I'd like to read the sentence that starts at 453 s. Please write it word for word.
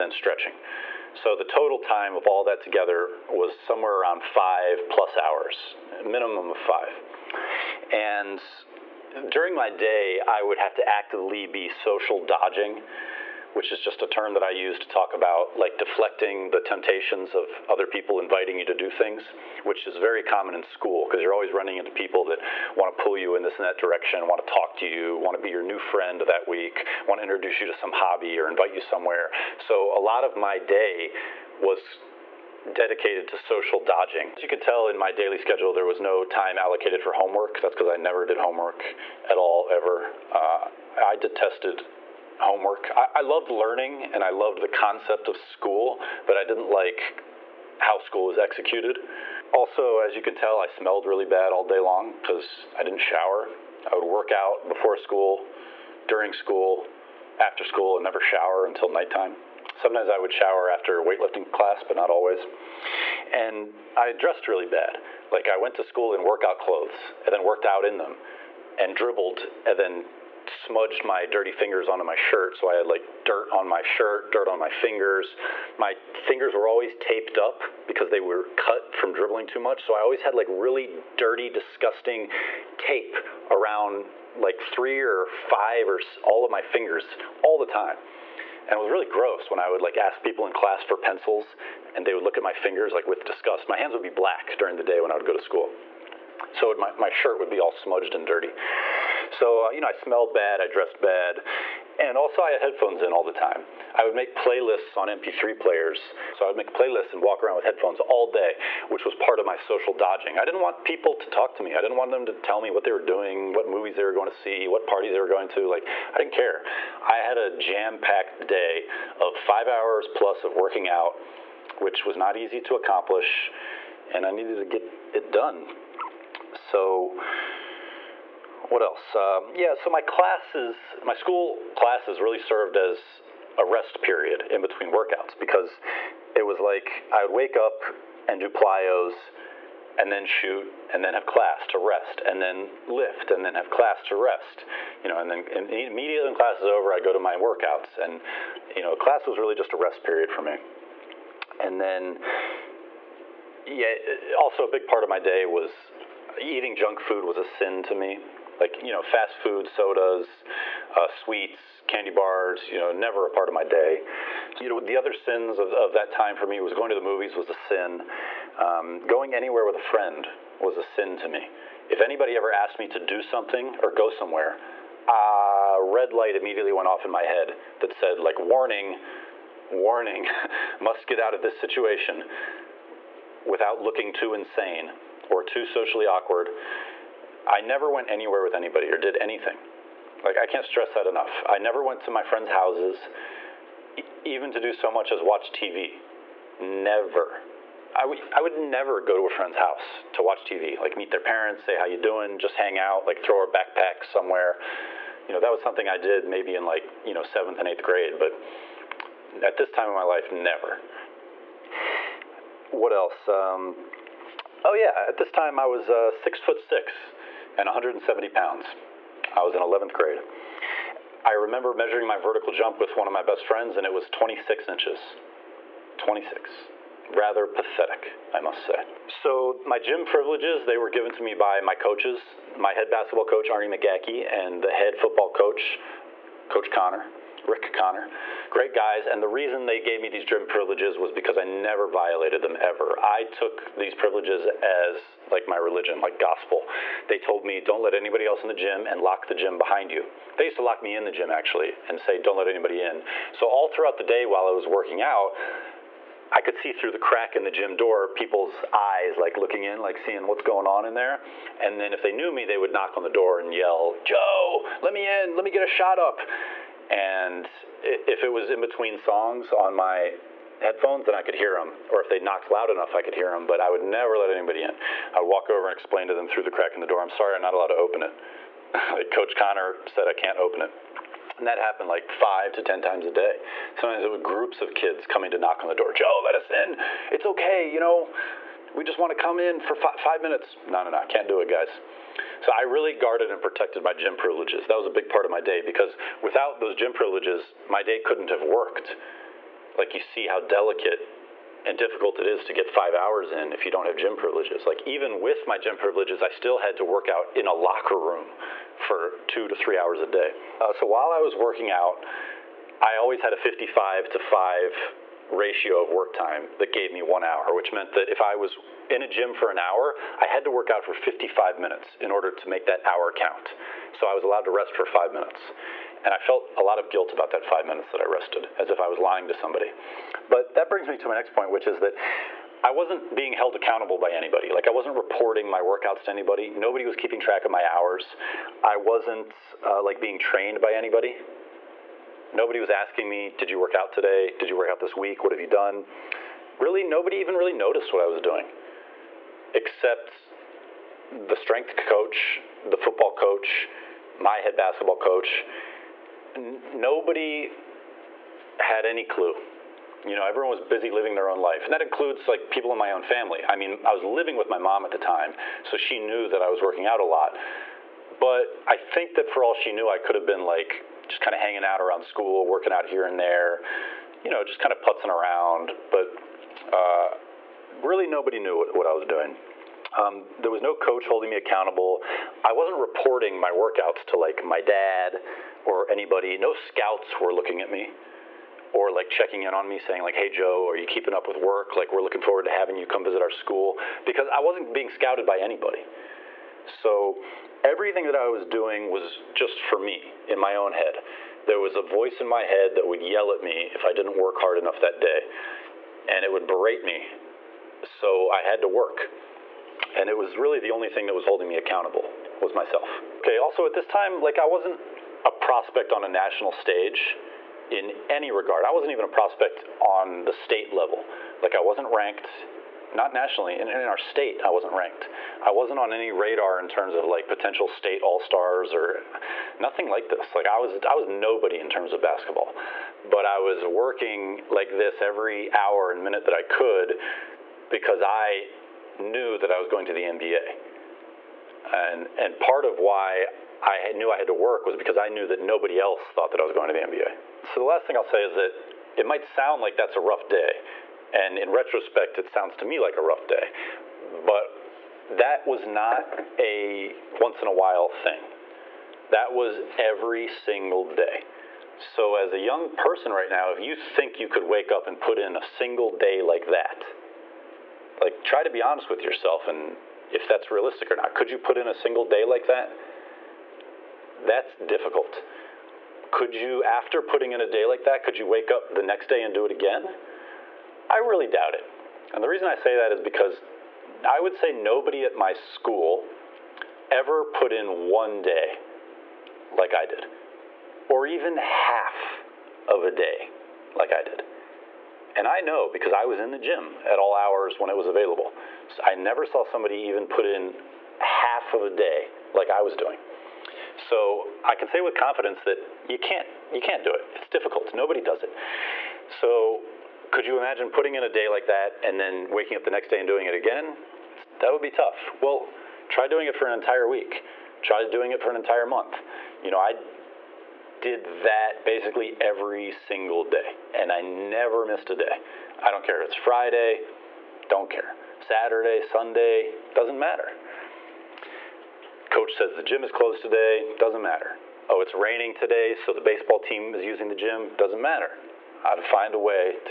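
But that was not a once in a while thing.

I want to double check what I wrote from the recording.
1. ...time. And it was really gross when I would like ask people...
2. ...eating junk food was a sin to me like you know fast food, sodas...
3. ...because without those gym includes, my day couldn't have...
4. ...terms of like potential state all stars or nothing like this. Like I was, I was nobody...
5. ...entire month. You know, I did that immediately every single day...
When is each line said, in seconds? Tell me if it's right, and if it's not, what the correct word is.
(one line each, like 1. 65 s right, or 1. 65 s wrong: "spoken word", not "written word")
1. 87 s right
2. 156 s right
3. 295 s wrong: "privileges", not "includes"
4. 426 s right
5. 518 s wrong: "basically", not "immediately".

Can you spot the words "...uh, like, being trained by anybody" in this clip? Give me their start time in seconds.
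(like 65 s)
339 s.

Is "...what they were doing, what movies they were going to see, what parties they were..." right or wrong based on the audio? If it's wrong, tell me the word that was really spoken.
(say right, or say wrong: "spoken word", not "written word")
right.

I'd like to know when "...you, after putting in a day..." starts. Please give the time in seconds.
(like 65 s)
476 s.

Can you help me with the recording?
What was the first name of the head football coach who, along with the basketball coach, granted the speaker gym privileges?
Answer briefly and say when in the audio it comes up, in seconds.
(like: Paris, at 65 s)
Rick, at 237 s.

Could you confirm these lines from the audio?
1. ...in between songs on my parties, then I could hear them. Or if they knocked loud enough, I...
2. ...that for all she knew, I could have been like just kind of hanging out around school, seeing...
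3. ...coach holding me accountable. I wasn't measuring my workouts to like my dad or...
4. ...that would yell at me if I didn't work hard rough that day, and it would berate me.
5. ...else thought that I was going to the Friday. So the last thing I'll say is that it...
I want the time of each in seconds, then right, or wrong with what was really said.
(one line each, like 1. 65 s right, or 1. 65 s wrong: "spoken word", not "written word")
1. 268 s wrong: "headphones", not "parties"
2. 369 s wrong: "working", not "seeing"
3. 380 s wrong: "reporting", not "measuring"
4. 402 s wrong: "enough", not "rough"
5. 445 s wrong: "NBA", not "Friday".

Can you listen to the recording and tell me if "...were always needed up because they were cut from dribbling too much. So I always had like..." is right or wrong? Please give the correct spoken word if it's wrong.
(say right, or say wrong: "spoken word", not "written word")
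wrong: "taped", not "needed".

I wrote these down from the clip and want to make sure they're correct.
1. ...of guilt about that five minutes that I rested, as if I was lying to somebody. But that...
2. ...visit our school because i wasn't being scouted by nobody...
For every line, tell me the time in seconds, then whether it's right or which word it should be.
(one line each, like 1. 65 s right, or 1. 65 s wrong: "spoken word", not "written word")
1. 326 s right
2. 393 s wrong: "anybody", not "nobody".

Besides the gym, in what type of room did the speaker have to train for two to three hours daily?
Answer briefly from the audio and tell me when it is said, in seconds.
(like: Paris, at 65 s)
locker room, at 307 s.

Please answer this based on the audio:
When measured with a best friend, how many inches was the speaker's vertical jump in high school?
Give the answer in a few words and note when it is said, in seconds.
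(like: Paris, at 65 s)
26 inches, at 224 s.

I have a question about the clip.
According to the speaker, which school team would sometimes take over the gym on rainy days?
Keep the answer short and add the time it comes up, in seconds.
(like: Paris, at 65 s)
baseball team, at 535 s.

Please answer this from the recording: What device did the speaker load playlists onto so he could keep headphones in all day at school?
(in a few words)
MP3 players.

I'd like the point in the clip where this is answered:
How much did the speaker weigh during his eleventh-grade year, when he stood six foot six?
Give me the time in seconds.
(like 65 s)
217 s.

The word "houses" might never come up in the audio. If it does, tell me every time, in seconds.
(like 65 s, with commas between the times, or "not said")
192 s, 199 s.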